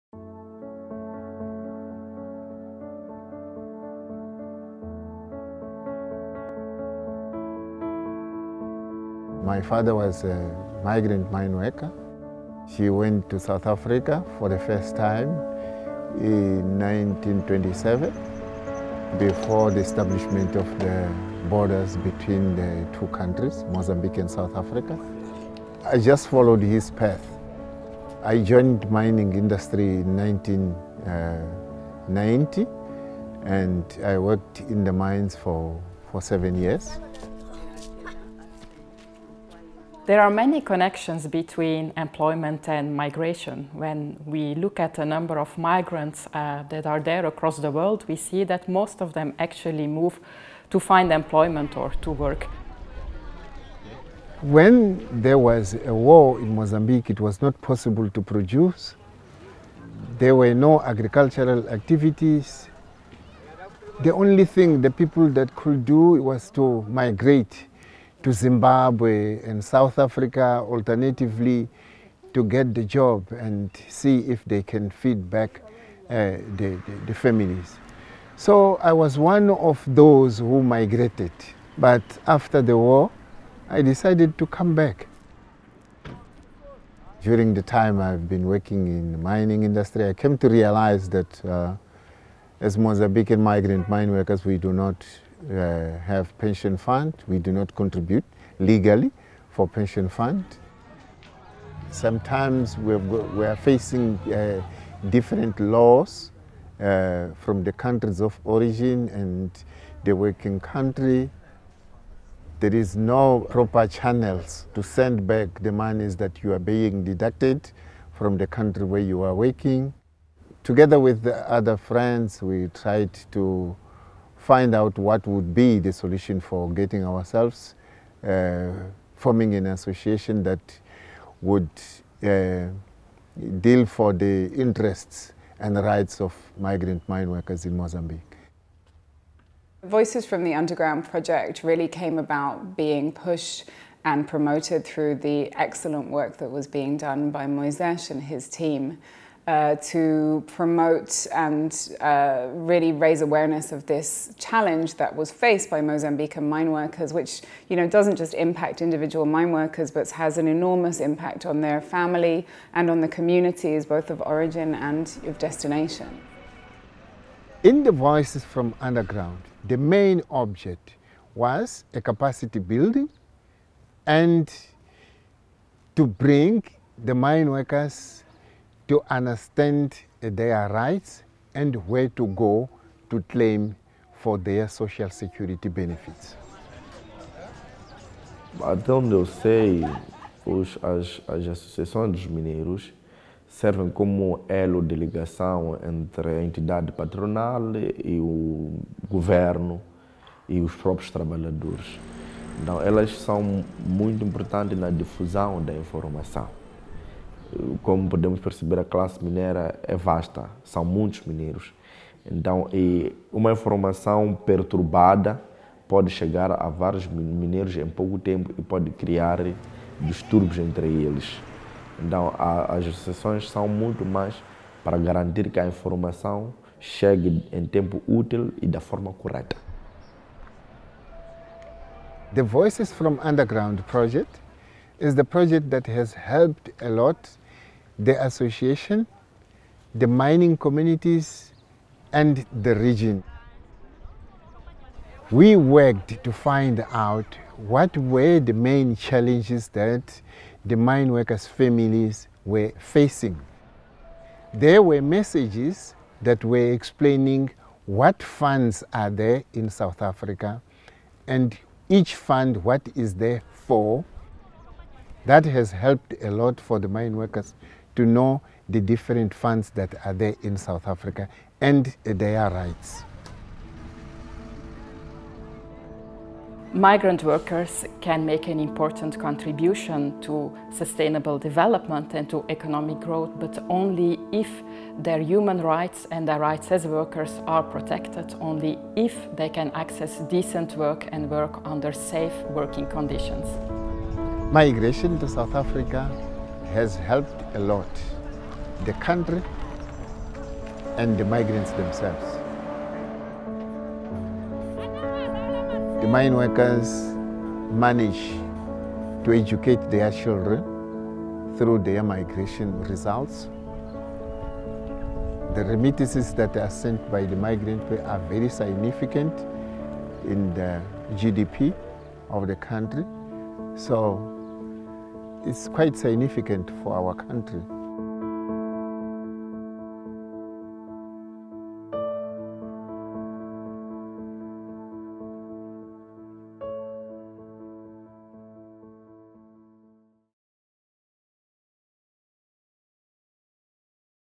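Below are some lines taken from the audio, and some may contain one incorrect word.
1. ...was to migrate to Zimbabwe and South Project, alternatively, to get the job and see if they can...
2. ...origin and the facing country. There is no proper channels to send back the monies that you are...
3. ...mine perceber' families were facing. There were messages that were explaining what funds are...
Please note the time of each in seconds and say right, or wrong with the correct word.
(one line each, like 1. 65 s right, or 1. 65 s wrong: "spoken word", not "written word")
1. 66 s wrong: "Africa", not "Project"
2. 108 s wrong: "working", not "facing"
3. 250 s wrong: "workers", not "perceber".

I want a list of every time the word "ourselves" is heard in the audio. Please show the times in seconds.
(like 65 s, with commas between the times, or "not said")
127 s.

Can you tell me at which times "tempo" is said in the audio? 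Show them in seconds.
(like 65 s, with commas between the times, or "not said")
218 s, 227 s.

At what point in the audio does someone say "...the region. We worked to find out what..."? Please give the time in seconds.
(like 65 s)
242 s.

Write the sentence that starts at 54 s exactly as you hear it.
When there was a war in Mozambique, it was not possible to produce.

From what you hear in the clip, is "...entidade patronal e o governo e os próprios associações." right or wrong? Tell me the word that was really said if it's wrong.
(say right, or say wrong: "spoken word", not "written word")
wrong: "trabalhadores", not "associações".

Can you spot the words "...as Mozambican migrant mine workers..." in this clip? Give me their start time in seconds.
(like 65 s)
92 s.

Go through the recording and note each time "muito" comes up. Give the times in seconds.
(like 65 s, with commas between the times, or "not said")
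203 s, 210 s, 223 s.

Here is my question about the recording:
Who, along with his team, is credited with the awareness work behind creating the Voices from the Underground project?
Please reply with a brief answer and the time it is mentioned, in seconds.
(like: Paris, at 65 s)
Moisés, at 147 s.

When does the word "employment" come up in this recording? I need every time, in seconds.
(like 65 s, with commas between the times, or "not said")
41 s, 51 s.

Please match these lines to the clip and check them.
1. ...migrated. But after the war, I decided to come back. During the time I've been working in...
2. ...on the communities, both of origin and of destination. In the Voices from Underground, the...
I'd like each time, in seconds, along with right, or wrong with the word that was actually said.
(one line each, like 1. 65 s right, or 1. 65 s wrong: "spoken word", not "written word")
1. 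80 s right
2. 162 s right.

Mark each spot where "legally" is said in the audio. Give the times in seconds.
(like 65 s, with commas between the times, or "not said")
98 s.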